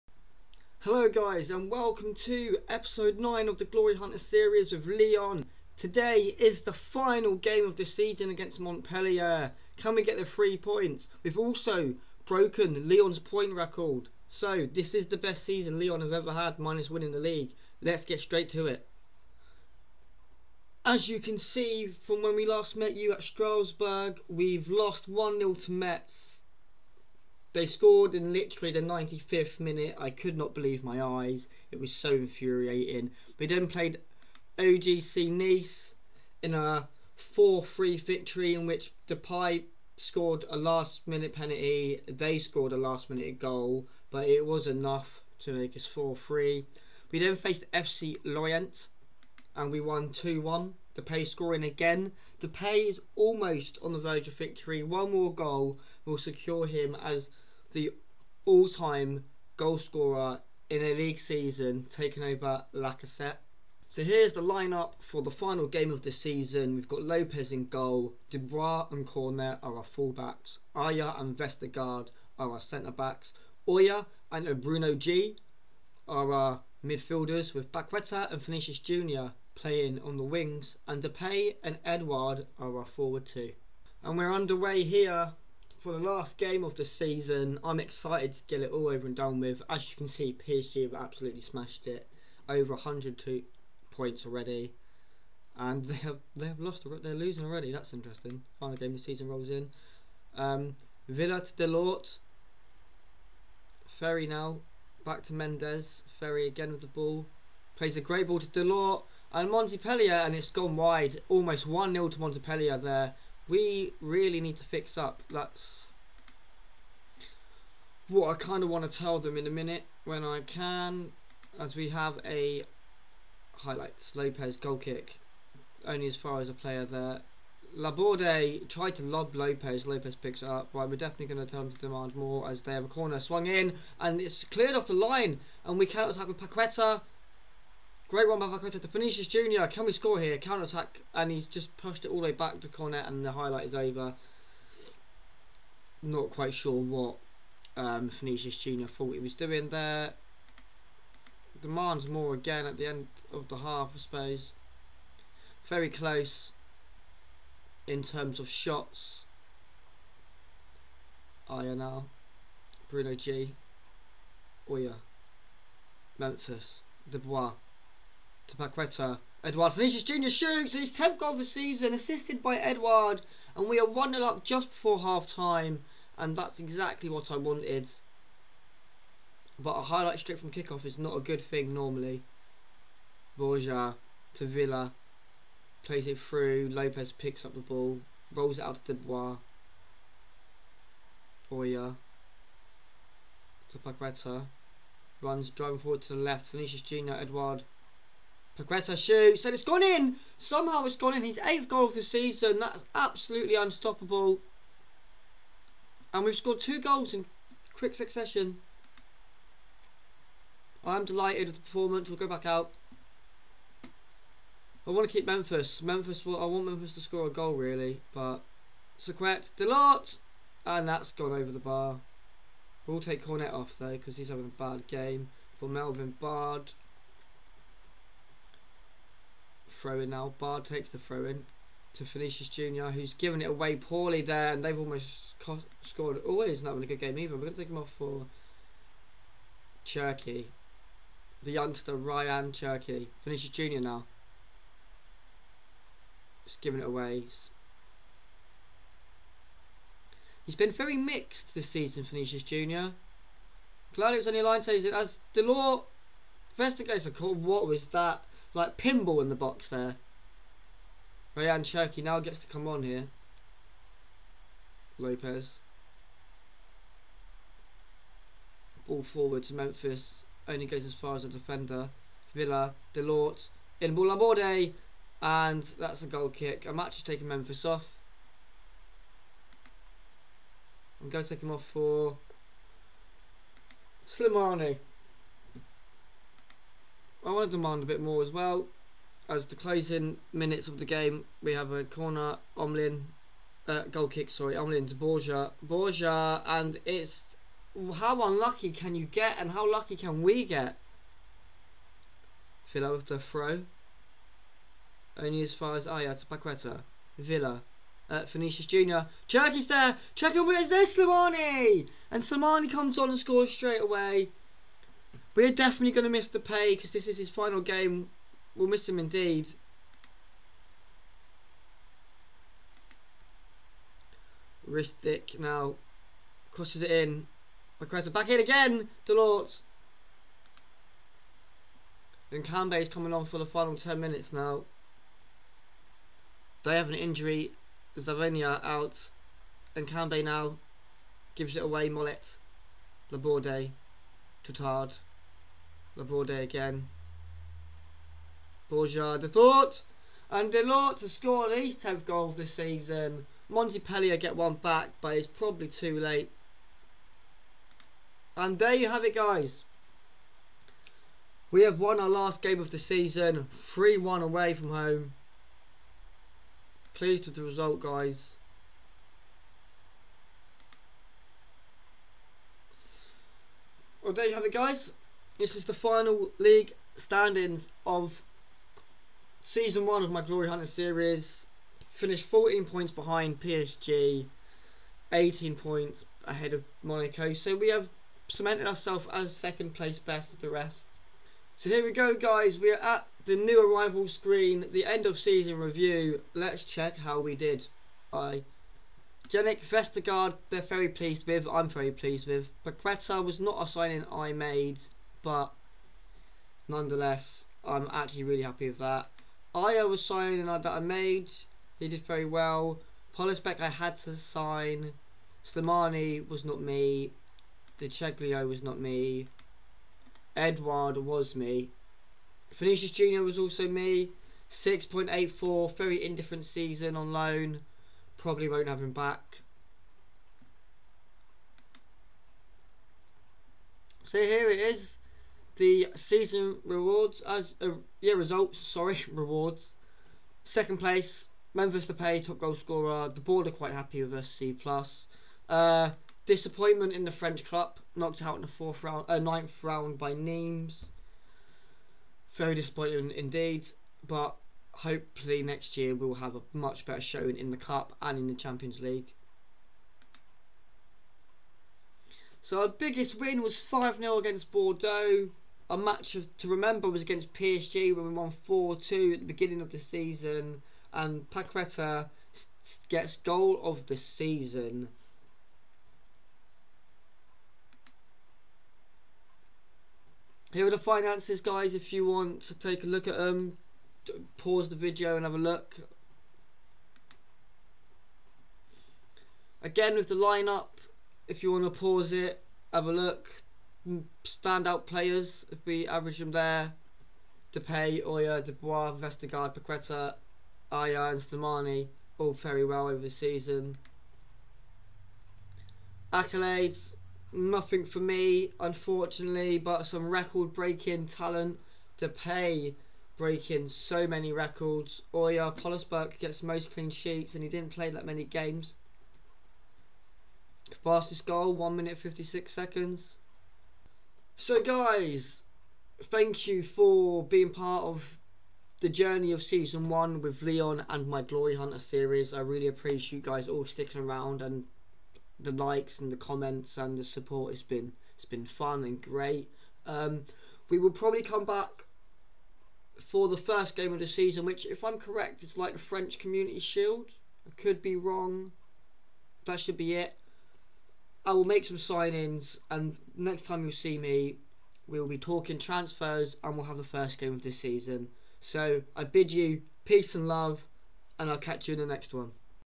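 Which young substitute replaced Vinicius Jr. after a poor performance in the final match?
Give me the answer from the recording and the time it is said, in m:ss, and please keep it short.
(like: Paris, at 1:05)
Rayan Cherki, at 4:01.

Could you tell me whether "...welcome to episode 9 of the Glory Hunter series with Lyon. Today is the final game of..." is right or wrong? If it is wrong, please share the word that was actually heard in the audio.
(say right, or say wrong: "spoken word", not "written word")
right.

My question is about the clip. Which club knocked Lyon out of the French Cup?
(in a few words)
Nimes.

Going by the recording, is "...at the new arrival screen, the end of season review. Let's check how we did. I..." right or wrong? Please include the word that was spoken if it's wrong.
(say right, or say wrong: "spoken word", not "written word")
right.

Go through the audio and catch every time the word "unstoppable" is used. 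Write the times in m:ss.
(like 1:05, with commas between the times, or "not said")
3:23.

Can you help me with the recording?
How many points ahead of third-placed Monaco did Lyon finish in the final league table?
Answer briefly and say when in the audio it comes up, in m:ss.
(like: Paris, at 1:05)
18, at 6:25.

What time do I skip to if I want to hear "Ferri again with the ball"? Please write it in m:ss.
1:46.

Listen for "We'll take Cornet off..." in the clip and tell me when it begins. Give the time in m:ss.
3:42.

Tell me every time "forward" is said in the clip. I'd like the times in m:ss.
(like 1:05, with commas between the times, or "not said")
1:22, 3:15, 4:29.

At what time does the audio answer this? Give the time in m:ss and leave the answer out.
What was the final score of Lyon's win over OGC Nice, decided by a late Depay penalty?
0:37.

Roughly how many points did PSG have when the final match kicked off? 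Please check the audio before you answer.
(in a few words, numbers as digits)
102.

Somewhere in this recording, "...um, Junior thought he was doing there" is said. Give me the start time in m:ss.
2:27.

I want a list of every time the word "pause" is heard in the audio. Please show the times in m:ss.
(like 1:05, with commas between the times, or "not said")
8:04, 8:11.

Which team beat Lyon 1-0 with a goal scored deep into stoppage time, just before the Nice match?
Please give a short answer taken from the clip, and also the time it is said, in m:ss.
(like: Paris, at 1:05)
Metz, at 0:25.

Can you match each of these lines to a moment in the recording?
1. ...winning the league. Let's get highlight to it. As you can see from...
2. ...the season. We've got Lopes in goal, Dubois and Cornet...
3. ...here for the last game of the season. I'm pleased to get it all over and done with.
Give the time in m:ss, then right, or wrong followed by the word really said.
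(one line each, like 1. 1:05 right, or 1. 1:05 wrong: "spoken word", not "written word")
1. 0:16 wrong: "straight", not "highlight"
2. 1:06 right
3. 1:24 wrong: "excited", not "pleased".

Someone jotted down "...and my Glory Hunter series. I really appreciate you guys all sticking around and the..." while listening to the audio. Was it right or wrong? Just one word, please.
right.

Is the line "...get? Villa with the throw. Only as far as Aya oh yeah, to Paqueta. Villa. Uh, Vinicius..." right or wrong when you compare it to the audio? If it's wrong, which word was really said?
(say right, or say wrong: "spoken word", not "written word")
right.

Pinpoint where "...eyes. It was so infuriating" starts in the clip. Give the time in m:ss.
0:31.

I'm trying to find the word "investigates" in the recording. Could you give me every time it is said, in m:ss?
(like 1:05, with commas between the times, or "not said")
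4:16.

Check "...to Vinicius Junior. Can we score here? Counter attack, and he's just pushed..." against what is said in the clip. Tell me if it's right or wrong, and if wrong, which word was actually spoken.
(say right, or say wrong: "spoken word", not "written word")
right.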